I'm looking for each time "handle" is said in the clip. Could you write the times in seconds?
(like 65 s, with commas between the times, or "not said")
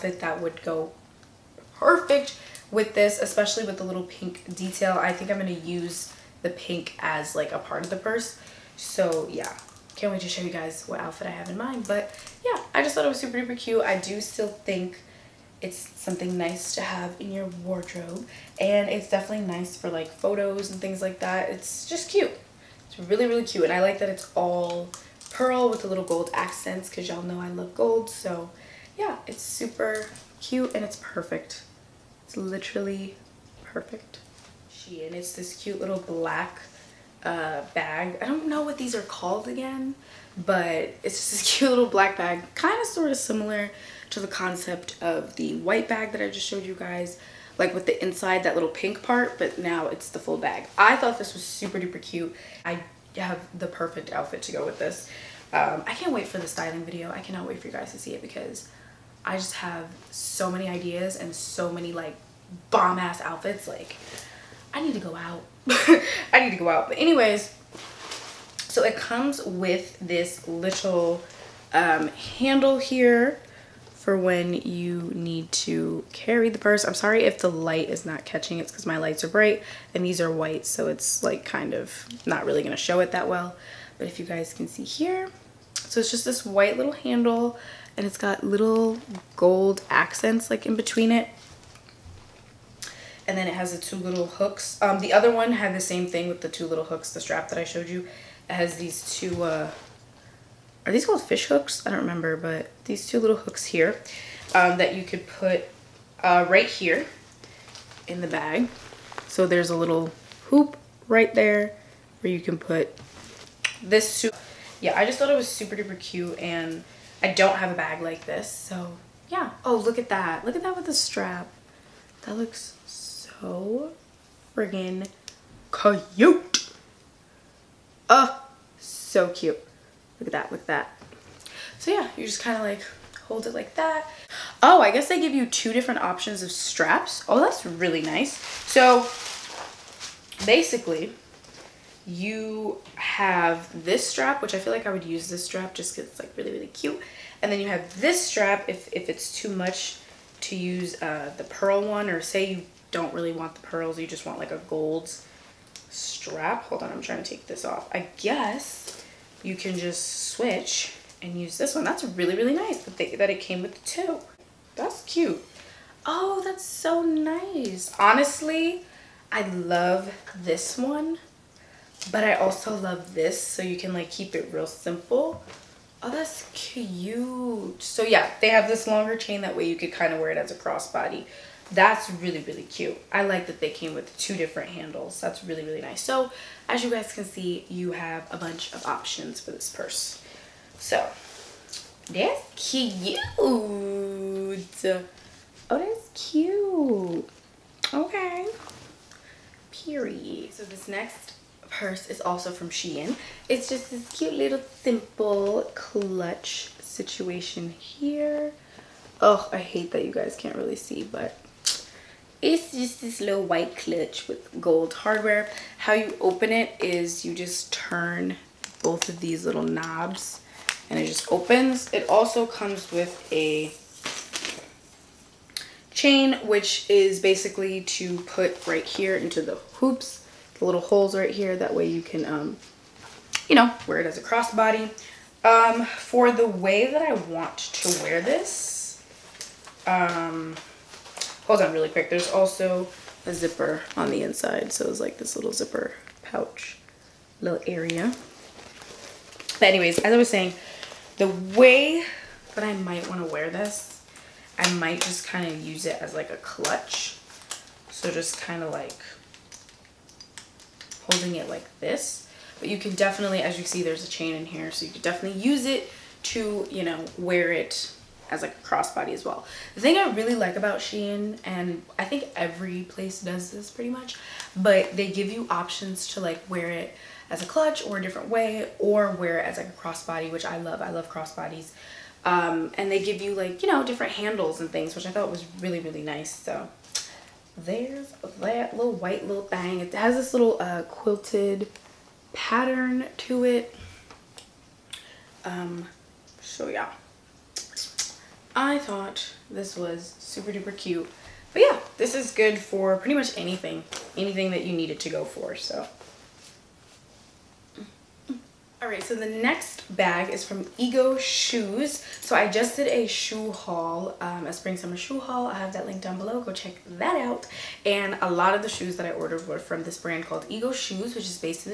72 s, 86 s, 184 s, 284 s.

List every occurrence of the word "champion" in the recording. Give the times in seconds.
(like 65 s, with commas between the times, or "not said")
not said.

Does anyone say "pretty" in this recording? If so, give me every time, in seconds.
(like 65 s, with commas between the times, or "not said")
273 s, 302 s.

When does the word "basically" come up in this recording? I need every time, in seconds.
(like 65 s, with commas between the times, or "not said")
140 s, 227 s.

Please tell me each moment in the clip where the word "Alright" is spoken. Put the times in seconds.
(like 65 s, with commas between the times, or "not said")
308 s.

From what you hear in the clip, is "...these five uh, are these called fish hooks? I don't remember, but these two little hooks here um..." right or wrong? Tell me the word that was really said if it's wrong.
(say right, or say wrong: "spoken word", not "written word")
wrong: "two", not "five".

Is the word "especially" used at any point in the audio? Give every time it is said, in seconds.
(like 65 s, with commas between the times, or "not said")
3 s.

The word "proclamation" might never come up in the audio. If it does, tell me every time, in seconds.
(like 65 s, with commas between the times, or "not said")
not said.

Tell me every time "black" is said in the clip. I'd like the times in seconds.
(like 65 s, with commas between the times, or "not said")
35 s, 41 s.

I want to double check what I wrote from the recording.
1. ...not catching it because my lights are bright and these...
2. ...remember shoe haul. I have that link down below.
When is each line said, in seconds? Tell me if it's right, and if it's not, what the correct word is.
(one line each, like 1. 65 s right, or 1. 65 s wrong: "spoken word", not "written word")
1. 78 s right
2. 314 s wrong: "summer", not "remember".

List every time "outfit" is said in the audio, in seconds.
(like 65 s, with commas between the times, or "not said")
10 s, 54 s, 63 s.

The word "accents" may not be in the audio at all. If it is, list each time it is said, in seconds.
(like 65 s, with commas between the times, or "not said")
26 s, 89 s.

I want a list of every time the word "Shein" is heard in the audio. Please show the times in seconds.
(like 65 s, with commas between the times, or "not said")
202 s, 270 s.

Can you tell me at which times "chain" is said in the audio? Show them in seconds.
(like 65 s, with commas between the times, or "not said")
179 s, 225 s, 264 s.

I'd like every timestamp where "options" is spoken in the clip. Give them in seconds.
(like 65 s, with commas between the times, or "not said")
135 s, 188 s, 275 s.